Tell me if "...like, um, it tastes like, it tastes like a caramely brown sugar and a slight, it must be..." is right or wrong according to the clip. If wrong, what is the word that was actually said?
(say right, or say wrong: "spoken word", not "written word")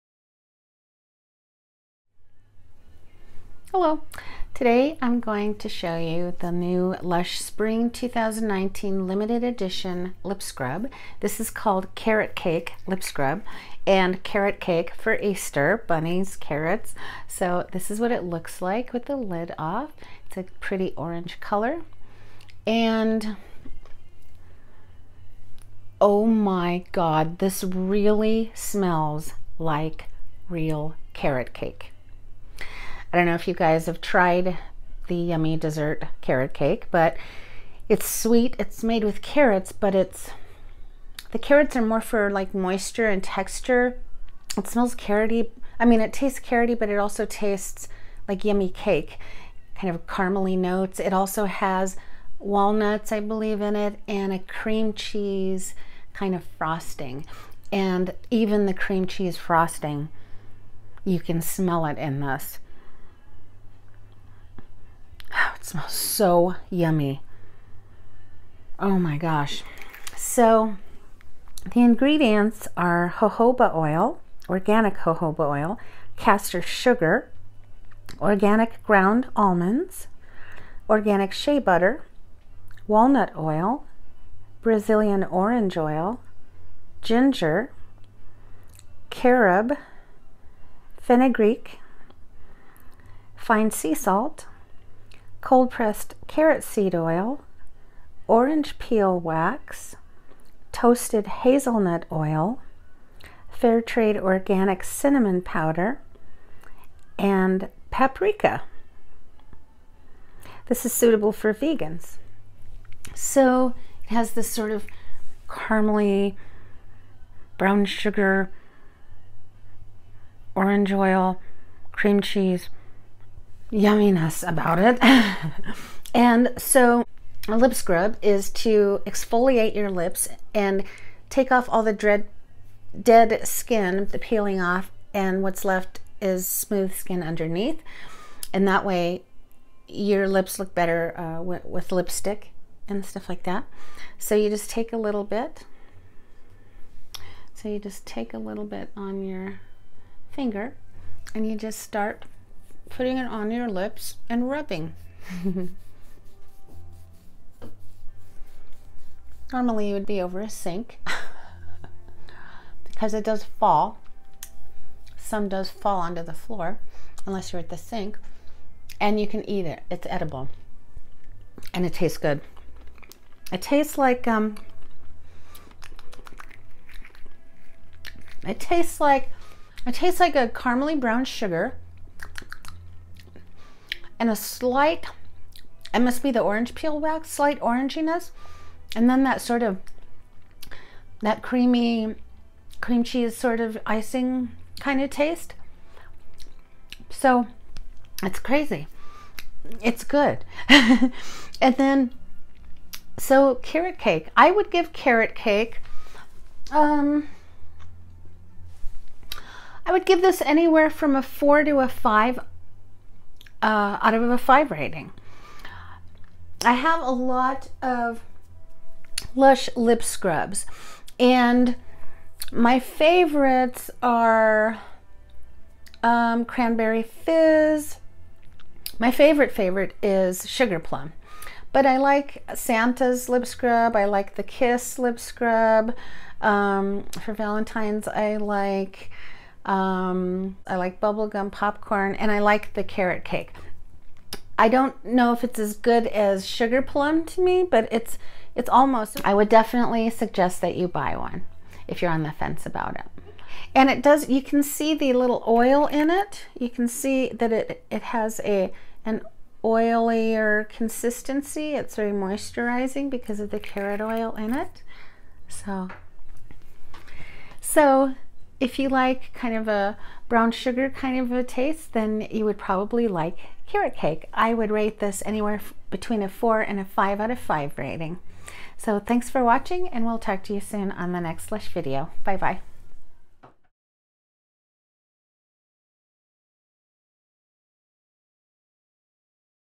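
right.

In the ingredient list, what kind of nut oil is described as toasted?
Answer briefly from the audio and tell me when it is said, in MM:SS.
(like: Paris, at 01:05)
hazelnut oil, at 01:40.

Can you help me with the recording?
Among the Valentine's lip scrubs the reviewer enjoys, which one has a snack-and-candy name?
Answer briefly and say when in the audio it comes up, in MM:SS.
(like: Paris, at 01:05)
Bubblegum Popcorn, at 04:00.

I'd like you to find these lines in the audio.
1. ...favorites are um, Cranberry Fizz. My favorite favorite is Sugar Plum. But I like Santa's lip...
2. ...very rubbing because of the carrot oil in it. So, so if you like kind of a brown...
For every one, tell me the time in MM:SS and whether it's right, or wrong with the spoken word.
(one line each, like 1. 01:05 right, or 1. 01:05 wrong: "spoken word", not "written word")
1. 03:42 right
2. 04:21 wrong: "moisturizing", not "rubbing".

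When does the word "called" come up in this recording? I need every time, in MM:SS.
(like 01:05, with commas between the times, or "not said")
00:11.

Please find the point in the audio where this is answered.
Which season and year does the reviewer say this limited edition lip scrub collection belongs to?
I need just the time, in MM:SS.
00:07.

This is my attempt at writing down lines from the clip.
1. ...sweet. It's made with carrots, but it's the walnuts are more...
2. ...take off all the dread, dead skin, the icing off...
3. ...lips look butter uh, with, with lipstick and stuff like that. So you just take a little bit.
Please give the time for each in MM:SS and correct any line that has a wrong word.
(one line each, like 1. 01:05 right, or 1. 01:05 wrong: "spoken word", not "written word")
1. 00:38 wrong: "carrots", not "walnuts"
2. 02:11 wrong: "peeling", not "icing"
3. 02:20 wrong: "better", not "butter".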